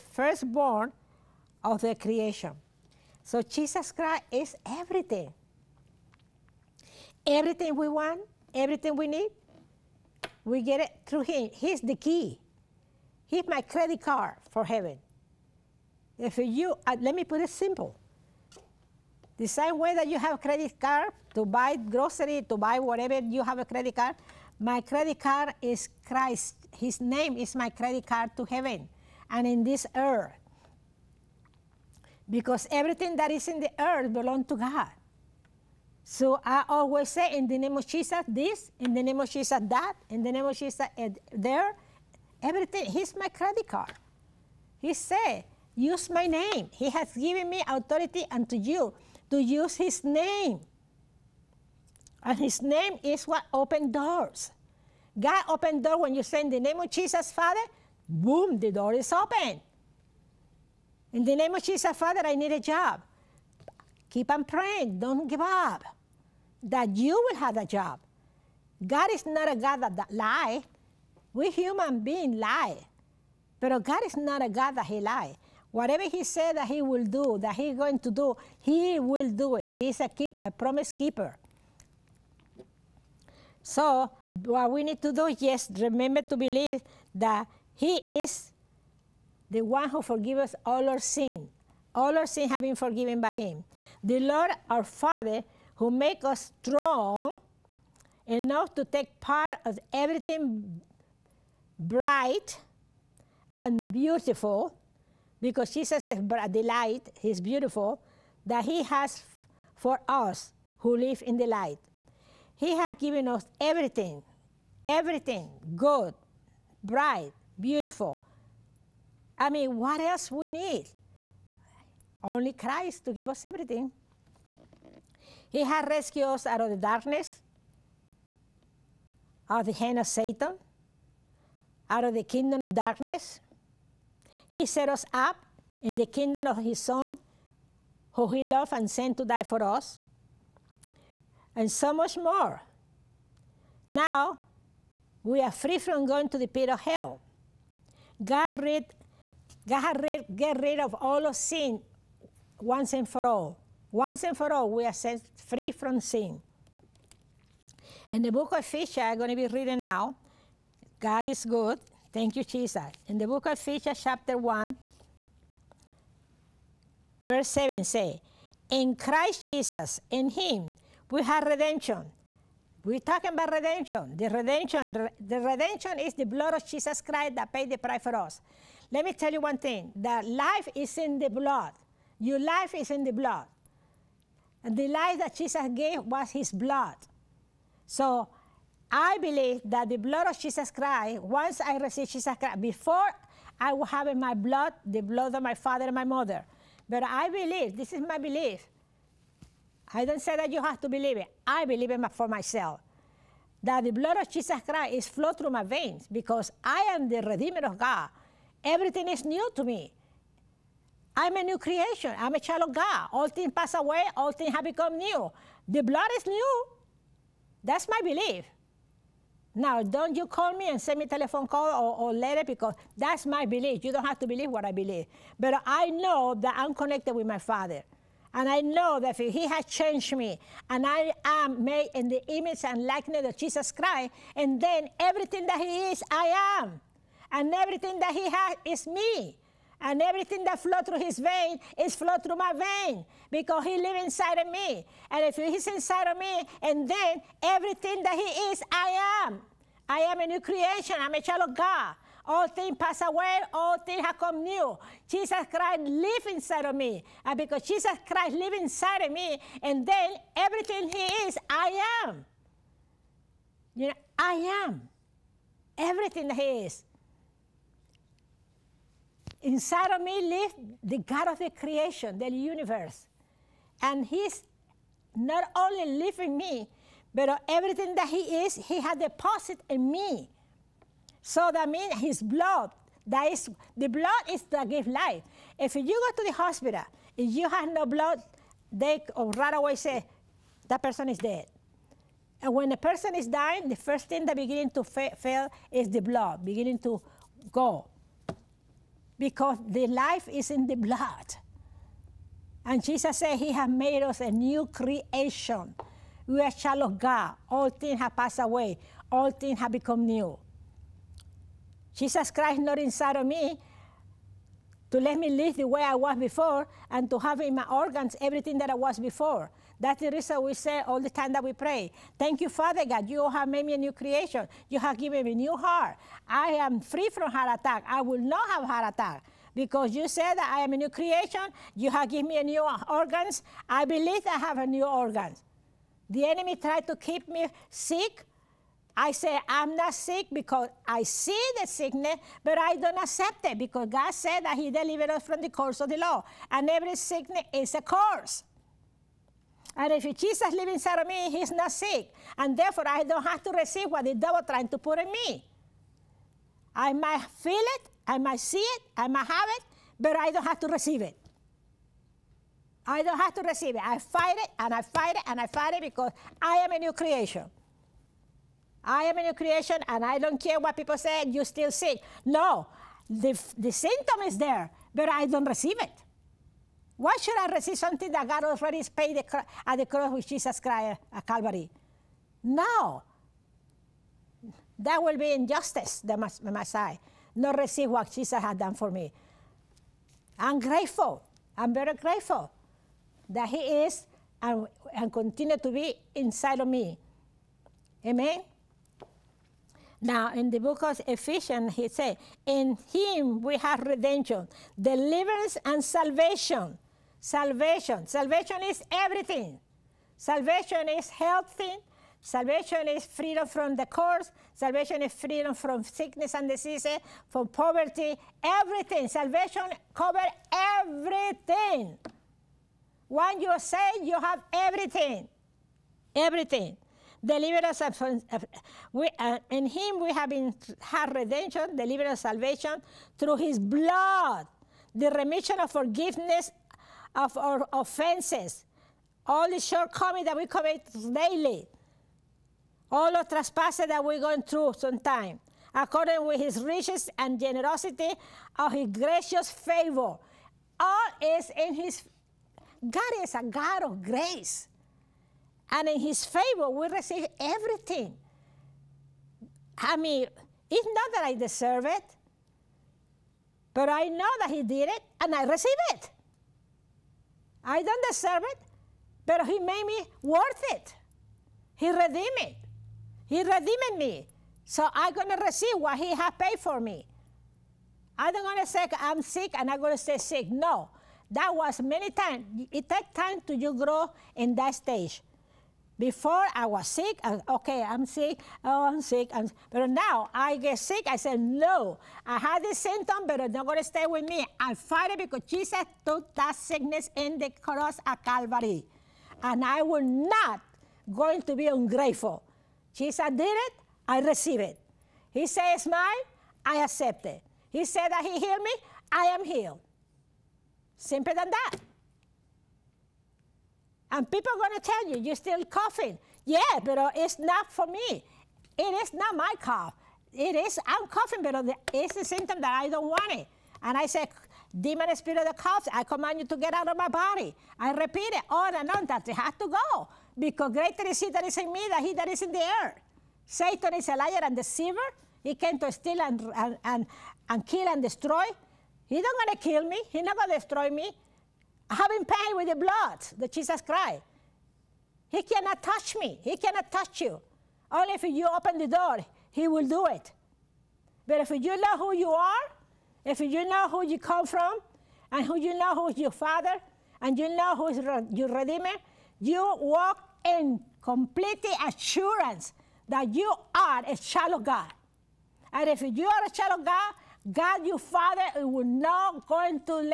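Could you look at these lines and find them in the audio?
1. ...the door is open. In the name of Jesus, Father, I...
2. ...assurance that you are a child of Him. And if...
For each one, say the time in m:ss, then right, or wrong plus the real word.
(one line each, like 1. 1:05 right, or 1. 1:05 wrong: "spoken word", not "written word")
1. 0:58 right
2. 9:21 wrong: "God", not "Him".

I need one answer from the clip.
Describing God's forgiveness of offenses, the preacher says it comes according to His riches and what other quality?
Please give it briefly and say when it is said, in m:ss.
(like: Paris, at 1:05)
generosity, at 7:27.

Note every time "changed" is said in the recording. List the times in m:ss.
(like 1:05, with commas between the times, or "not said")
3:49.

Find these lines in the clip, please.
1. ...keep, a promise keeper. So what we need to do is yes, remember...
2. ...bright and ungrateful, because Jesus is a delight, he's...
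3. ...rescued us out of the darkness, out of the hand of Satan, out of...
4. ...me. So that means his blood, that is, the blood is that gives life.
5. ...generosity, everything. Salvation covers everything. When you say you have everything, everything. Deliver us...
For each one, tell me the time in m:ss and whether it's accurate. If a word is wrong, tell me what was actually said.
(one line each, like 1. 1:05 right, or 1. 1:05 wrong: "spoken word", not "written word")
1. 1:20 right
2. 1:41 wrong: "beautiful", not "ungrateful"
3. 2:05 right
4. 4:39 right
5. 6:57 wrong: "poverty", not "generosity".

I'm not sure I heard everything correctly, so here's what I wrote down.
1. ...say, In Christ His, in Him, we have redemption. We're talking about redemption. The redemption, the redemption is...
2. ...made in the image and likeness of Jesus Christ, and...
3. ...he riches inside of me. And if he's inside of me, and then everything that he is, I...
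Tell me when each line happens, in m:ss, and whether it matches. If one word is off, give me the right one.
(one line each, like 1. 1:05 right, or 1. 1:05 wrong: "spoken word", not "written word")
1. 2:47 wrong: "Jesus", not "His"
2. 3:51 right
3. 4:03 wrong: "lives", not "riches".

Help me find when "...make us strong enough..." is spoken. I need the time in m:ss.
1:35.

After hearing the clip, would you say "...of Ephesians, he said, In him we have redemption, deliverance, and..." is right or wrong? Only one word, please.
right.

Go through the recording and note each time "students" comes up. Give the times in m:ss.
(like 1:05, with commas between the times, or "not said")
not said.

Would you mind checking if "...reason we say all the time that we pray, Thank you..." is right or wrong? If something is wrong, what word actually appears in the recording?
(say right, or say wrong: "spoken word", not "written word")
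right.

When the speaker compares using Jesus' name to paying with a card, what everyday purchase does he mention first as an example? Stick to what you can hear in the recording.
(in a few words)
grocery.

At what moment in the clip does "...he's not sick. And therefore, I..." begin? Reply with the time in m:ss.
5:51.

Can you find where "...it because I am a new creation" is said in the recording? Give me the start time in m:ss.
6:05.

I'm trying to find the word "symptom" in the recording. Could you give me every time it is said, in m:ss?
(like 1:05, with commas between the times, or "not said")
6:13, 8:12, 8:42.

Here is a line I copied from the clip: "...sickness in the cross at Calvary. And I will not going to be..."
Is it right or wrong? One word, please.
right.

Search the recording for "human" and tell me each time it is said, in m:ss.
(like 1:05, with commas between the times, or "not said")
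1:11.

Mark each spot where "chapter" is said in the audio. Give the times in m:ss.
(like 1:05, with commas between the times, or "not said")
2:44.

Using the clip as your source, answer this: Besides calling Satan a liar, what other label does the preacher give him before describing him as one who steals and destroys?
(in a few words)
deceiver.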